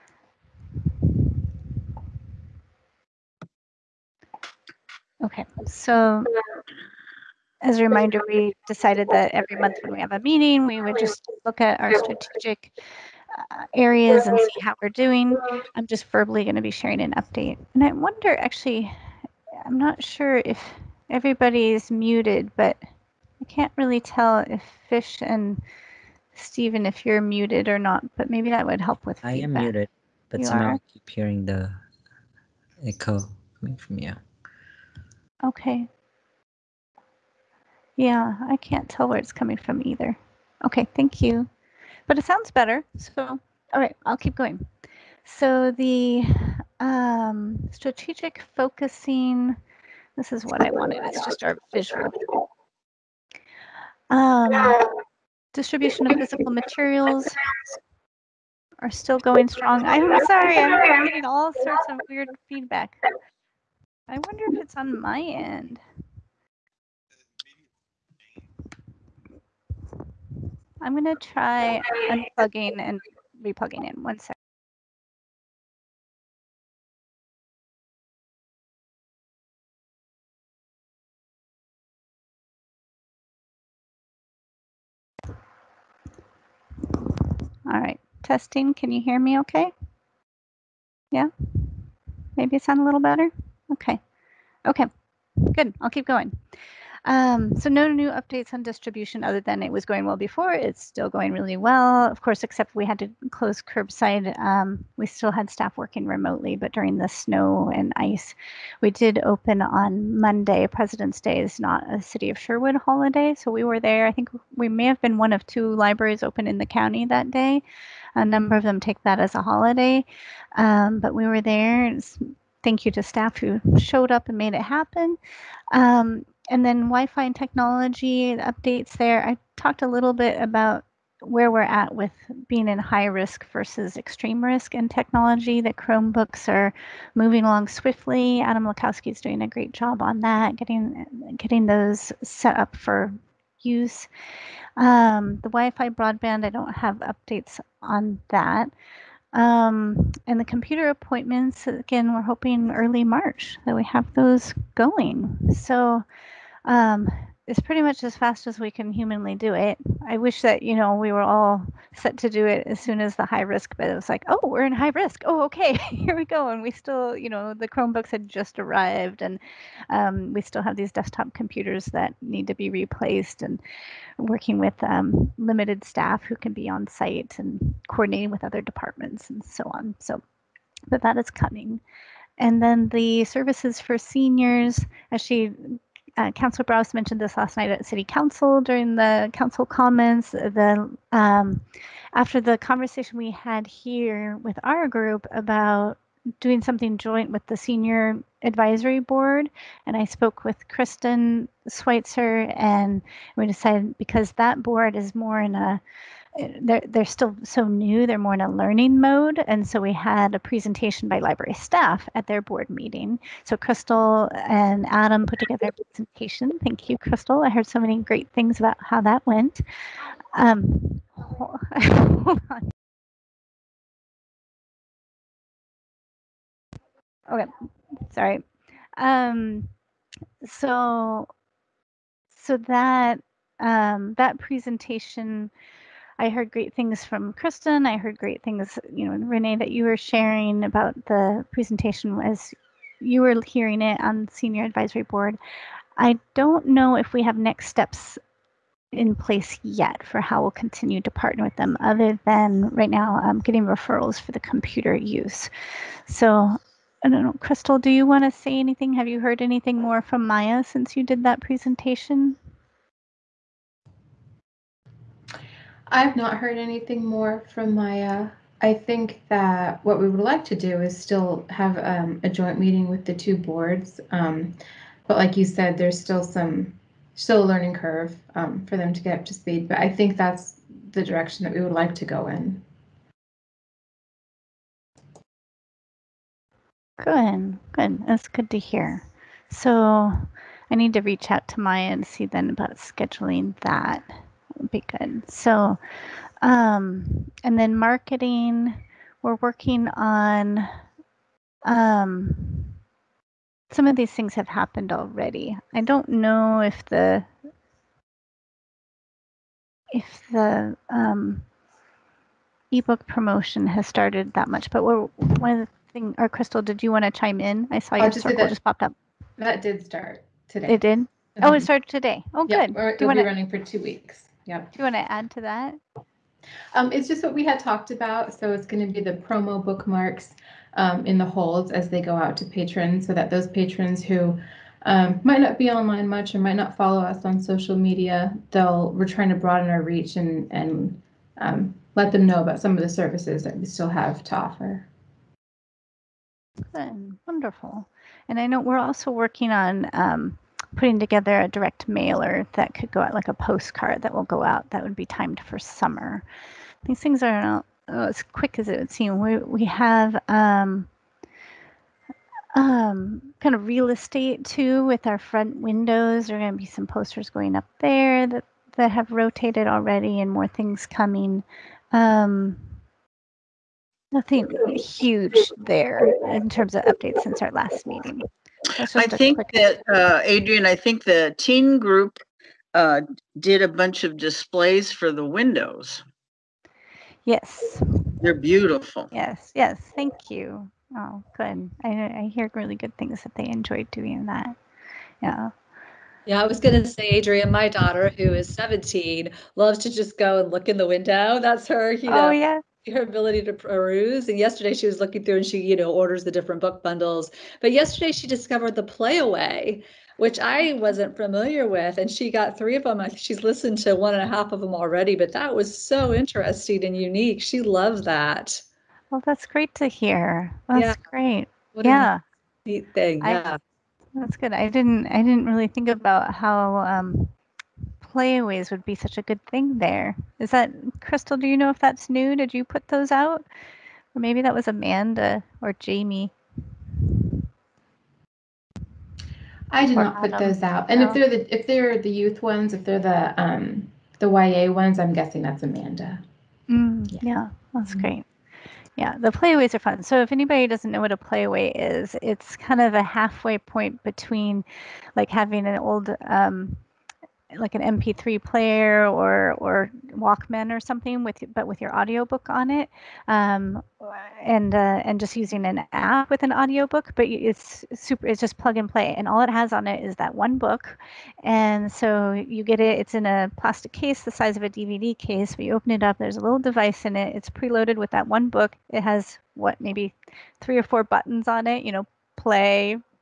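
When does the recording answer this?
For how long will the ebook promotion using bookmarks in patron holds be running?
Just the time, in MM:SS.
05:23.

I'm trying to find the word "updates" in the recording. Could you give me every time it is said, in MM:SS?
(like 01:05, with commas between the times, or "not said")
00:17, 01:38, 02:08, 02:27, 06:16.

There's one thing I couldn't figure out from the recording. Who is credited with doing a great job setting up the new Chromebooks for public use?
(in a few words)
Adam Lakowski.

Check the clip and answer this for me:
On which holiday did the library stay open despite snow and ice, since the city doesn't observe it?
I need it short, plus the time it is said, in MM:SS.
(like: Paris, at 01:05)
President's Day, at 01:50.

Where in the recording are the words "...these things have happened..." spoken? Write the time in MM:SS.
05:03.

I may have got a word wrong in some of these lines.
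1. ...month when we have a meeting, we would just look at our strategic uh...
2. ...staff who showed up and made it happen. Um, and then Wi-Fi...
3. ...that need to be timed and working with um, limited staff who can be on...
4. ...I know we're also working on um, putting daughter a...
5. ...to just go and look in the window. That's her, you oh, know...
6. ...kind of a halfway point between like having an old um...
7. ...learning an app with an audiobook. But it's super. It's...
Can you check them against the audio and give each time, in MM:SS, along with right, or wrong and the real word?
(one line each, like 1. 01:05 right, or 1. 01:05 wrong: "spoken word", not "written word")
1. 00:09 right
2. 02:03 right
3. 02:51 wrong: "replaced", not "timed"
4. 05:48 wrong: "together", not "daughter"
5. 06:39 right
6. 07:32 right
7. 07:45 wrong: "using", not "learning".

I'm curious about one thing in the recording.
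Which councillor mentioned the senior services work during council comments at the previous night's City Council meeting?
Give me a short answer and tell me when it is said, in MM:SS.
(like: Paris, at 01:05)
Councillor Brouse, at 03:06.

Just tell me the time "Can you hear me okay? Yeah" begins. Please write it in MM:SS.
01:28.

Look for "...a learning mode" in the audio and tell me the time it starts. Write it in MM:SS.
03:28.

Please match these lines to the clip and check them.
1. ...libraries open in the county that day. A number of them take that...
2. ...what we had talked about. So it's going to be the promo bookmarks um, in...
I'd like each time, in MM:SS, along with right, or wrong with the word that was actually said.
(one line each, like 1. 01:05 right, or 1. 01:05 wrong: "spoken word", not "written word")
1. 01:55 right
2. 05:27 right.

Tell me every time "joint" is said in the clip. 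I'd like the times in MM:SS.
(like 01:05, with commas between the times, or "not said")
03:16, 04:32.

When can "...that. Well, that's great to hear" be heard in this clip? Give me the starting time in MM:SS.
06:58.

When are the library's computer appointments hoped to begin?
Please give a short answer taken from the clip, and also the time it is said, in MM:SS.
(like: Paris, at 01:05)
early March, at 02:32.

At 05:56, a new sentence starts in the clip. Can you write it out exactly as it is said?
These things are not oh, as quick as it would seem.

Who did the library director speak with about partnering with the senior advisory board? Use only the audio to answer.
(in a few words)
Kristen Switzer.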